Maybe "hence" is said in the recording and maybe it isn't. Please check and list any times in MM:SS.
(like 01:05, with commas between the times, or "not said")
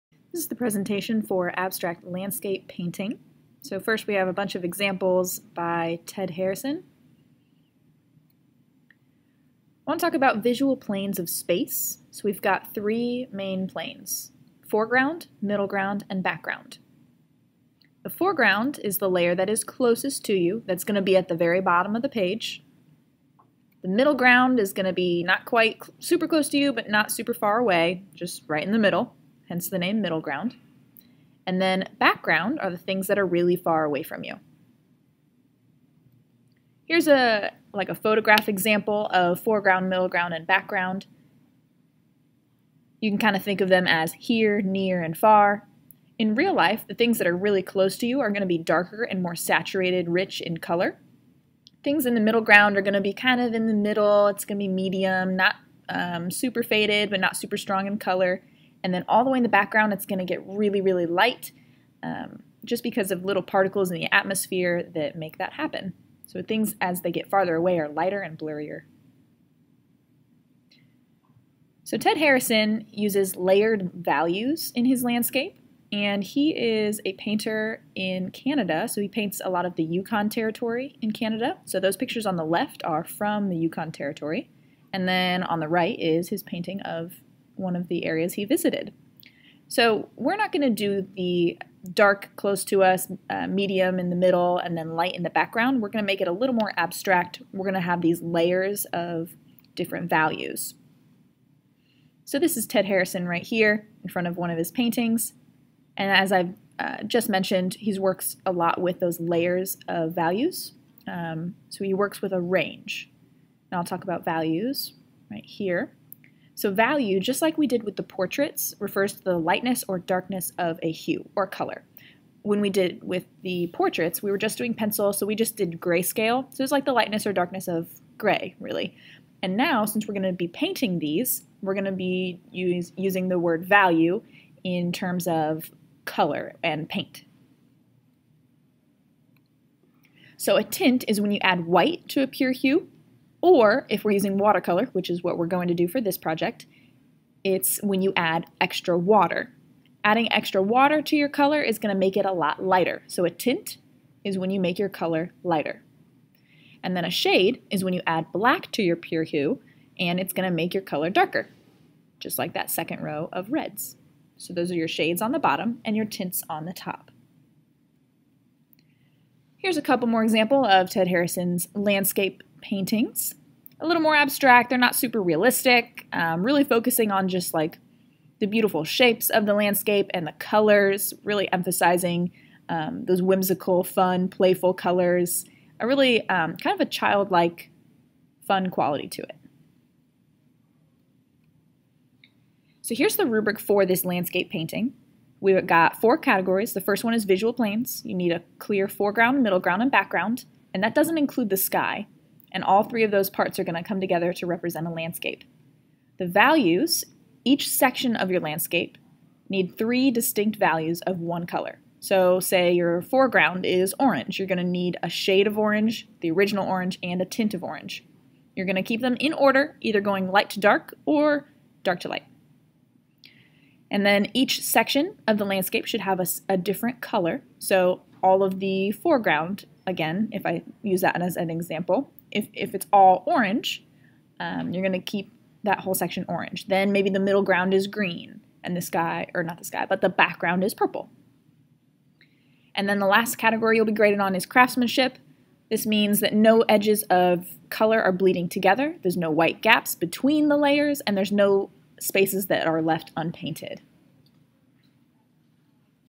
00:29.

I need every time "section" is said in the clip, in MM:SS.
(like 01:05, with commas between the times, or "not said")
03:27, 03:44, 03:55.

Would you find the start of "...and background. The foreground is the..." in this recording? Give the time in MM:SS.
00:16.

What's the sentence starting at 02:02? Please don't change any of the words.
When we did with the portraits, we were just doing pencil, so we just did grayscale.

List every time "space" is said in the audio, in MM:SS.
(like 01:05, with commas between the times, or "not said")
00:11, 04:11.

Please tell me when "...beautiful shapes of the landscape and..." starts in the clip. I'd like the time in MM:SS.
02:58.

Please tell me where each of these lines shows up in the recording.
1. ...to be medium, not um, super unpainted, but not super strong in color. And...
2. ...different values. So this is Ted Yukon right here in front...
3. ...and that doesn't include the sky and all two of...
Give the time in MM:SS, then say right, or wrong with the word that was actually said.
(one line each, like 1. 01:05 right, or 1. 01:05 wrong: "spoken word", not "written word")
1. 00:54 wrong: "faded", not "unpainted"
2. 01:39 wrong: "Harrison", not "Yukon"
3. 03:20 wrong: "three", not "two".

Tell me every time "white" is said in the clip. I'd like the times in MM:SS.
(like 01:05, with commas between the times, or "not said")
02:21, 04:09.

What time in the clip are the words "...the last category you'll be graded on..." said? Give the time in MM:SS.
04:02.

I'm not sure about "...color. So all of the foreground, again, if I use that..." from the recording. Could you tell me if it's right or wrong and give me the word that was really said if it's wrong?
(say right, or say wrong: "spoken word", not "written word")
right.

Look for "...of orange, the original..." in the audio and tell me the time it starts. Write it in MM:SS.
03:35.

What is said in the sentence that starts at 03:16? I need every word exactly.
The first one is visual planes.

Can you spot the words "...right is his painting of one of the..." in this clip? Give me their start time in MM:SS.
01:25.